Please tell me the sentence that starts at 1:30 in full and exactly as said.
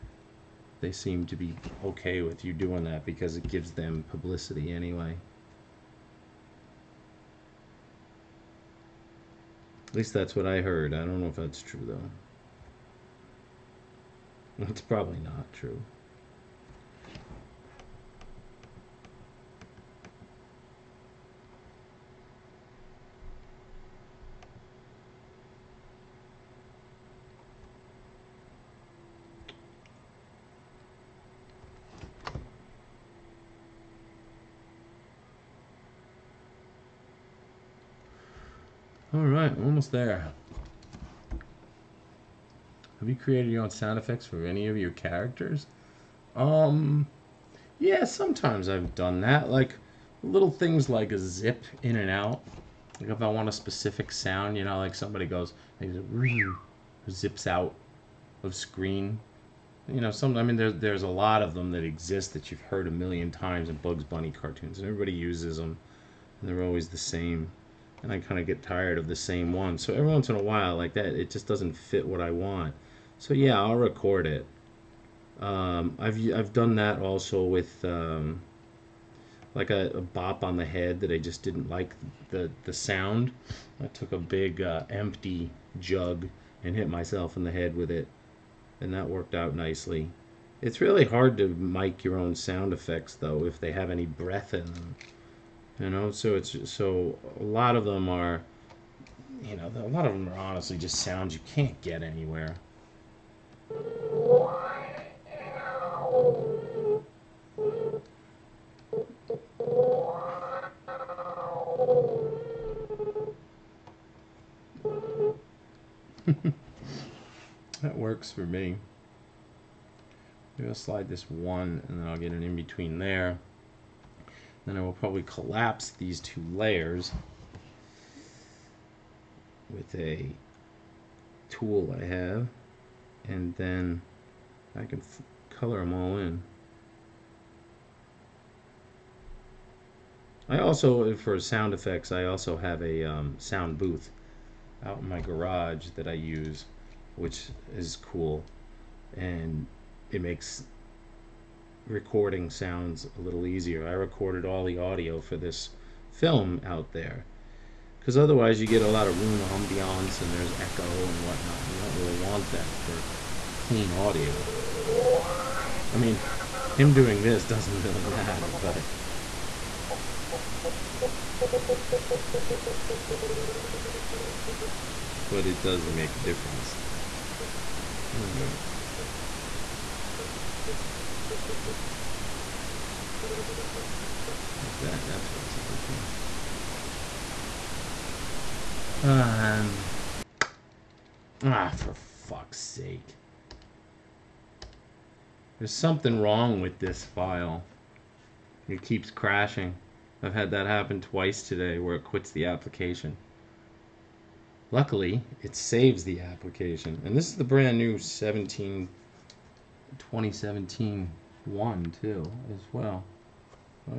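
It's really hard to mic your own sound effects though if they have any breath in them.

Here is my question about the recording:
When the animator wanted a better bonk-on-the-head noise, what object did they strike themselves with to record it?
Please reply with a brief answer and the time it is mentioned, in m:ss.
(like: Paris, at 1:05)
empty jug, at 1:24.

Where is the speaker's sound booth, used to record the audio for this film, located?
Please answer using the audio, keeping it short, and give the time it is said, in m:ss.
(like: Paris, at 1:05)
garage, at 2:25.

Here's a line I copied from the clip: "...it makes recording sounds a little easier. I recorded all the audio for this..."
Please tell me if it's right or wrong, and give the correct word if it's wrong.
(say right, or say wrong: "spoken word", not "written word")
right.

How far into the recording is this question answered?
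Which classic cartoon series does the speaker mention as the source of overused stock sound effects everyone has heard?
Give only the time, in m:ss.
1:03.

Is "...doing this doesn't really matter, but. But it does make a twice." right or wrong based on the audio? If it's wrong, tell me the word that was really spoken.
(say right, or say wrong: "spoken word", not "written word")
wrong: "difference", not "twice".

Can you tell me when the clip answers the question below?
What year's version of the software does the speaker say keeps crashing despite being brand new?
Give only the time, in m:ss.
3:29.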